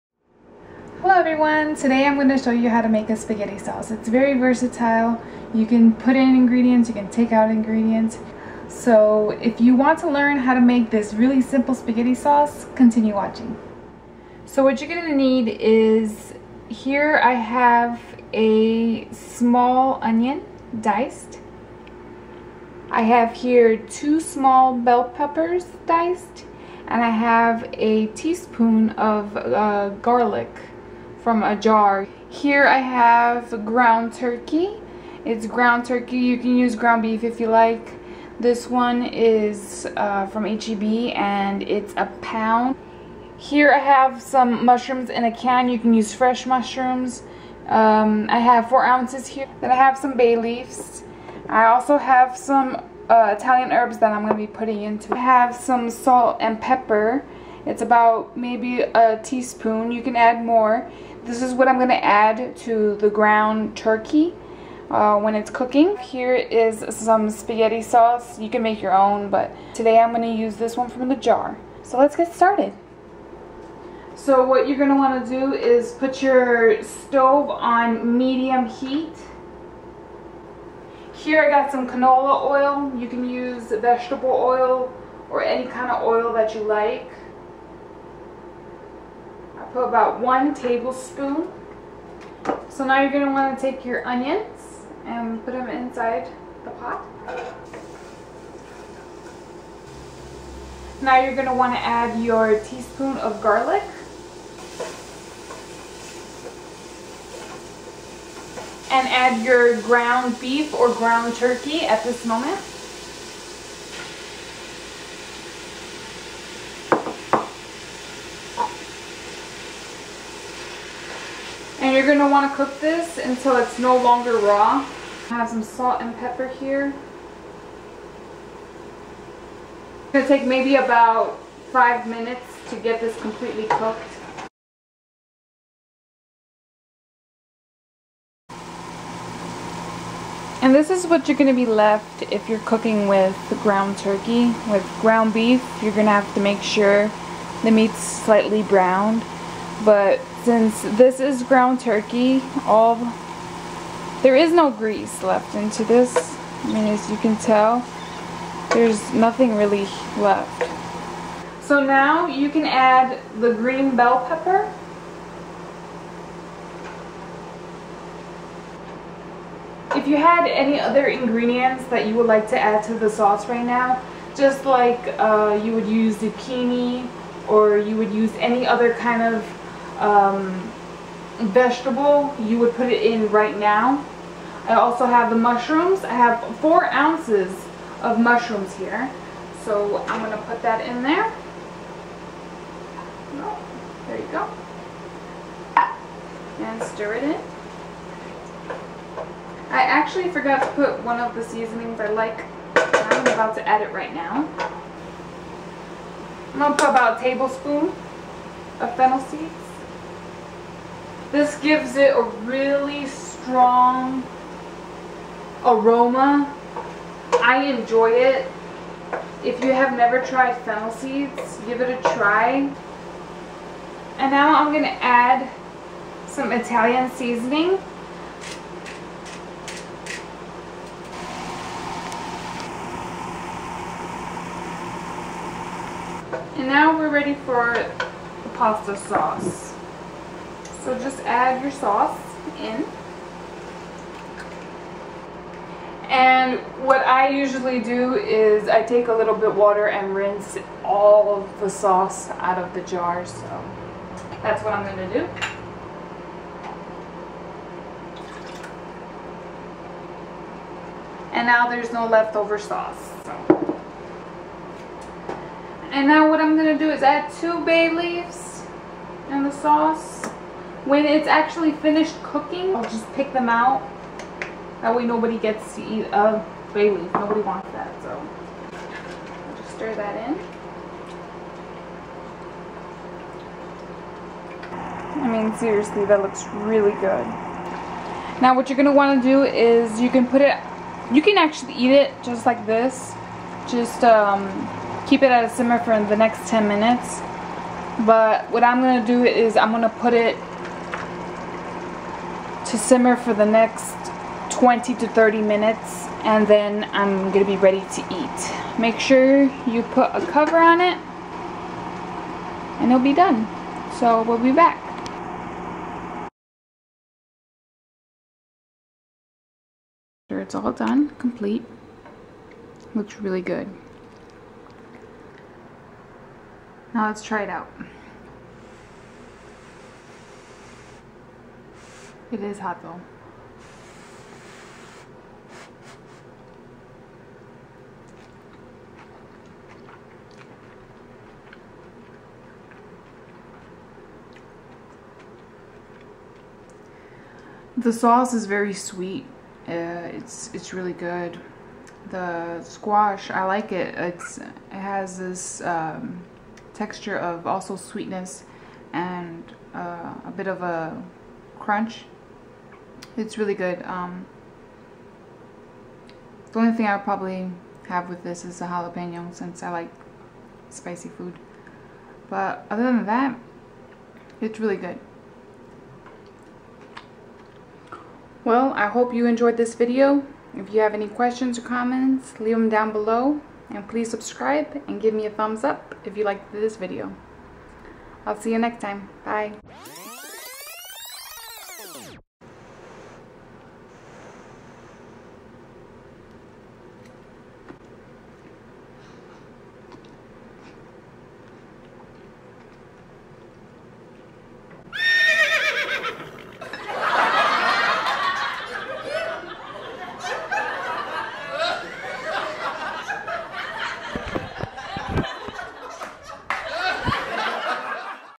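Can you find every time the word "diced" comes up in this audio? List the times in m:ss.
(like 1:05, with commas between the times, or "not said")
0:20, 0:25.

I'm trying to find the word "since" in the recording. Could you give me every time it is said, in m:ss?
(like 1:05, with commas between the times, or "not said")
2:30, 6:09.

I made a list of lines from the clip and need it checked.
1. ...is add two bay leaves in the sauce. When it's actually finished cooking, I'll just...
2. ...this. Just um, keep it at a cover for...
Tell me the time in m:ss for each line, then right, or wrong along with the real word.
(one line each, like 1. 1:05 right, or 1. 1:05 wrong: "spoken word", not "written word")
1. 4:26 right
2. 4:52 wrong: "simmer", not "cover".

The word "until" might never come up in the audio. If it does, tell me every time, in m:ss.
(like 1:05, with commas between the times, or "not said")
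2:03.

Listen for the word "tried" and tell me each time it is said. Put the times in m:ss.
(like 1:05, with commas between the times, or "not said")
3:40.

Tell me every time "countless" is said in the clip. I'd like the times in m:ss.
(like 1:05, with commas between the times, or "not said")
not said.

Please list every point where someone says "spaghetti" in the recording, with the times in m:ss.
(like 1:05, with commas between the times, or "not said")
0:03, 0:11, 1:07.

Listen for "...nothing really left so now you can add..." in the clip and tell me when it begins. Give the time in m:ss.
2:39.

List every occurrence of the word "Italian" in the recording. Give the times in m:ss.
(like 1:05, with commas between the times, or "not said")
0:53, 3:46.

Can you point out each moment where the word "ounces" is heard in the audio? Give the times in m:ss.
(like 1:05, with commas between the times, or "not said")
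0:48, 3:06.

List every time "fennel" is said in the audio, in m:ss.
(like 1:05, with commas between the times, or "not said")
3:28, 3:40.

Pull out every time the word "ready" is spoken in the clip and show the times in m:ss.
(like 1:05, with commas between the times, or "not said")
3:57, 5:07.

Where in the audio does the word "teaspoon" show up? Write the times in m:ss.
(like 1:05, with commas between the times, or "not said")
0:28, 0:59, 1:42.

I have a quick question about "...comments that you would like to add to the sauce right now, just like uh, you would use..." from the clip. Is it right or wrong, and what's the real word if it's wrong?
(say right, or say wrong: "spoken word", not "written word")
wrong: "ingredients", not "comments".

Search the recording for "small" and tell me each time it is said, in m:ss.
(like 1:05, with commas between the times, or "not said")
0:19, 0:24.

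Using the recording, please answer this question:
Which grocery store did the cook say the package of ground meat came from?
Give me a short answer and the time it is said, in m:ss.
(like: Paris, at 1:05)
HEB, at 0:40.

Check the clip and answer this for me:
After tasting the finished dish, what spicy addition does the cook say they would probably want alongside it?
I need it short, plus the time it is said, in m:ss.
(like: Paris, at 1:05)
jalapeno, at 6:08.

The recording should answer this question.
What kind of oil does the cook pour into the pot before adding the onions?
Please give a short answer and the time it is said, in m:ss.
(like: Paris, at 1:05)
canola oil, at 1:21.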